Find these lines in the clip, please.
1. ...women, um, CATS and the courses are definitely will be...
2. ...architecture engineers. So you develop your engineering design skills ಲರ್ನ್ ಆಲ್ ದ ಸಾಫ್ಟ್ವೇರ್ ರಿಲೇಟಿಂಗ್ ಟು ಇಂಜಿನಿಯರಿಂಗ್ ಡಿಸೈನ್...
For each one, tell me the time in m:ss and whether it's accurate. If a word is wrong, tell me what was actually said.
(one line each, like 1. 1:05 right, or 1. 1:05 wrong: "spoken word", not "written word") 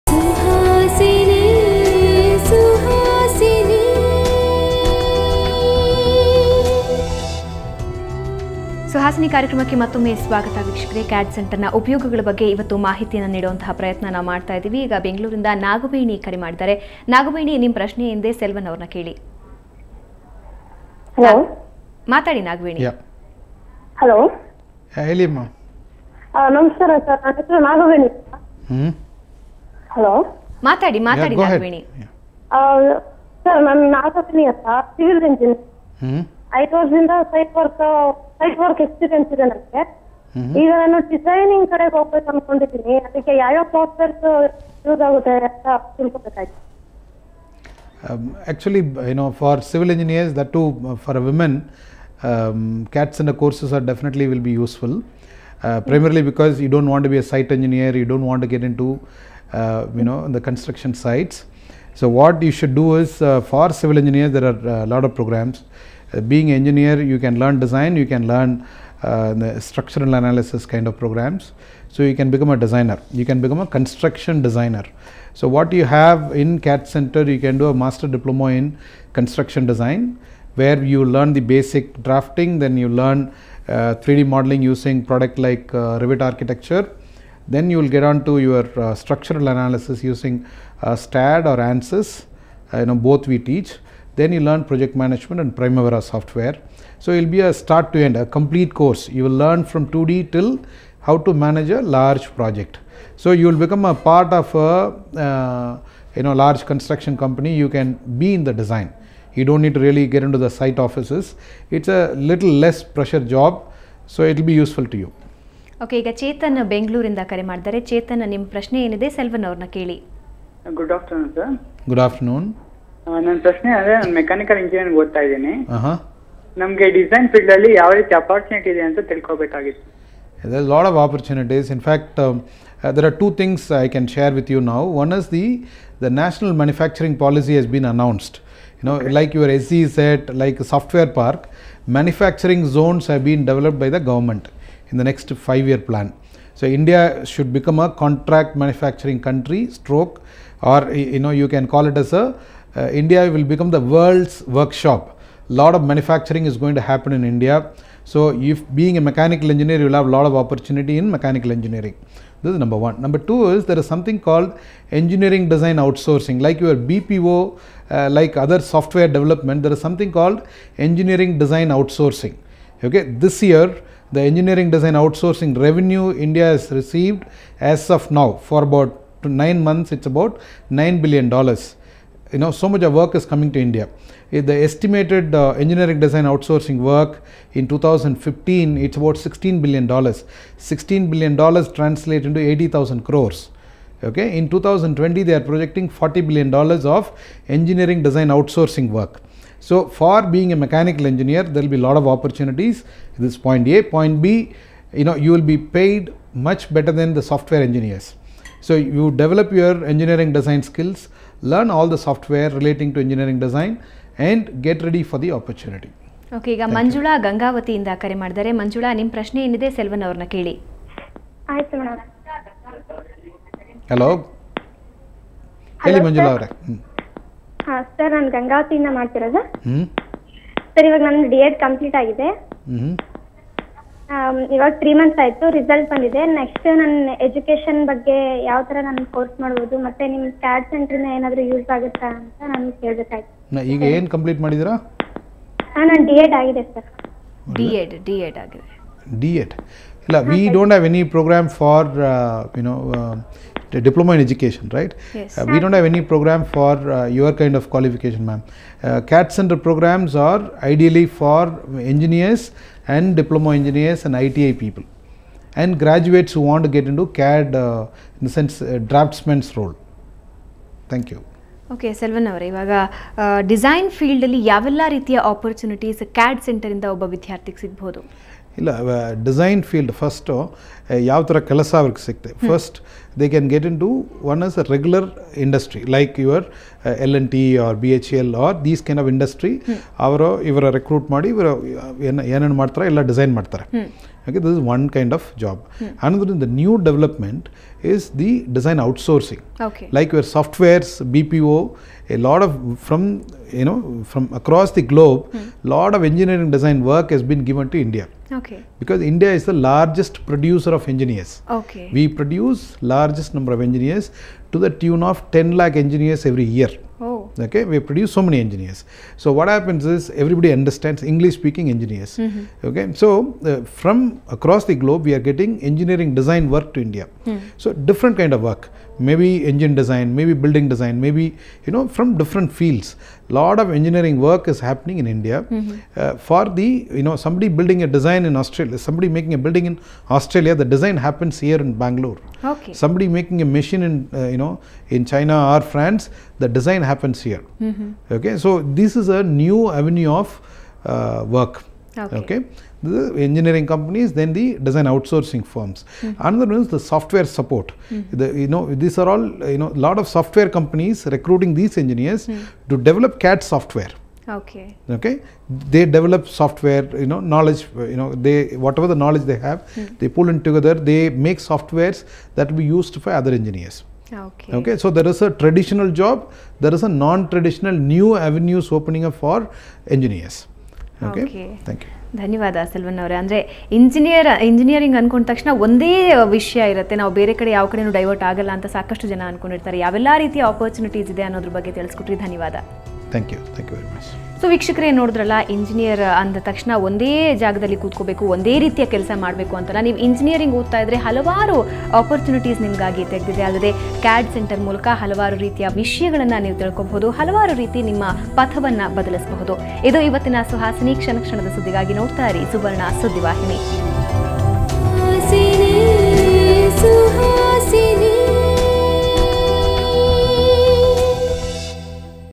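1. 0:51 right
2. 3:27 wrong: "software", not "architecture".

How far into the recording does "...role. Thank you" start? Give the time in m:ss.
4:29.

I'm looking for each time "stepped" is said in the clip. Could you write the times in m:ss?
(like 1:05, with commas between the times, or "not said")
not said.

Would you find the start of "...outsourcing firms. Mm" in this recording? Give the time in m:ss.
5:54.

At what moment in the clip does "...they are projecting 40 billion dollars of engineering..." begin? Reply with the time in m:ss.
3:15.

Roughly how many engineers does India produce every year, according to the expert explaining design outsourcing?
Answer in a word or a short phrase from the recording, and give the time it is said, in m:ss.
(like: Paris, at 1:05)
10 lakh, at 5:15.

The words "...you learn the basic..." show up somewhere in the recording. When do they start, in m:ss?
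1:20.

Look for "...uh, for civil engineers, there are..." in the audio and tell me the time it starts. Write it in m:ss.
1:03.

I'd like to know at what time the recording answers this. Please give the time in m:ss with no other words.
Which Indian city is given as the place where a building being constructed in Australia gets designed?
5:41.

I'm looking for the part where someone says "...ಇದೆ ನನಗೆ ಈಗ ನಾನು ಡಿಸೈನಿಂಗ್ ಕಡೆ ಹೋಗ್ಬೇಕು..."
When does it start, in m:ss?
0:39.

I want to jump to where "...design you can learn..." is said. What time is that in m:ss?
1:07.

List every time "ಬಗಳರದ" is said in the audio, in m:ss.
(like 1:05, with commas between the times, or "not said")
0:15, 1:56.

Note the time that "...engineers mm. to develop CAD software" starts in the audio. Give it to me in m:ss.
6:01.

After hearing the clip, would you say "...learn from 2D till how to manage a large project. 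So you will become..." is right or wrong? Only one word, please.
right.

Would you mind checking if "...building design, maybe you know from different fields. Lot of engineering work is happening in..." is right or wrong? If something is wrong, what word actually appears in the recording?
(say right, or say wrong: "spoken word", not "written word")
right.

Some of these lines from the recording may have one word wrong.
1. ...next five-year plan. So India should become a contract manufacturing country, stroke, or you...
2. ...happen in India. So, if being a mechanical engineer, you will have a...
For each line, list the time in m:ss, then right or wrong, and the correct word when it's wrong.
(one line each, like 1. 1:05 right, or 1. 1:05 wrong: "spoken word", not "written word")
1. 2:25 right
2. 2:36 right.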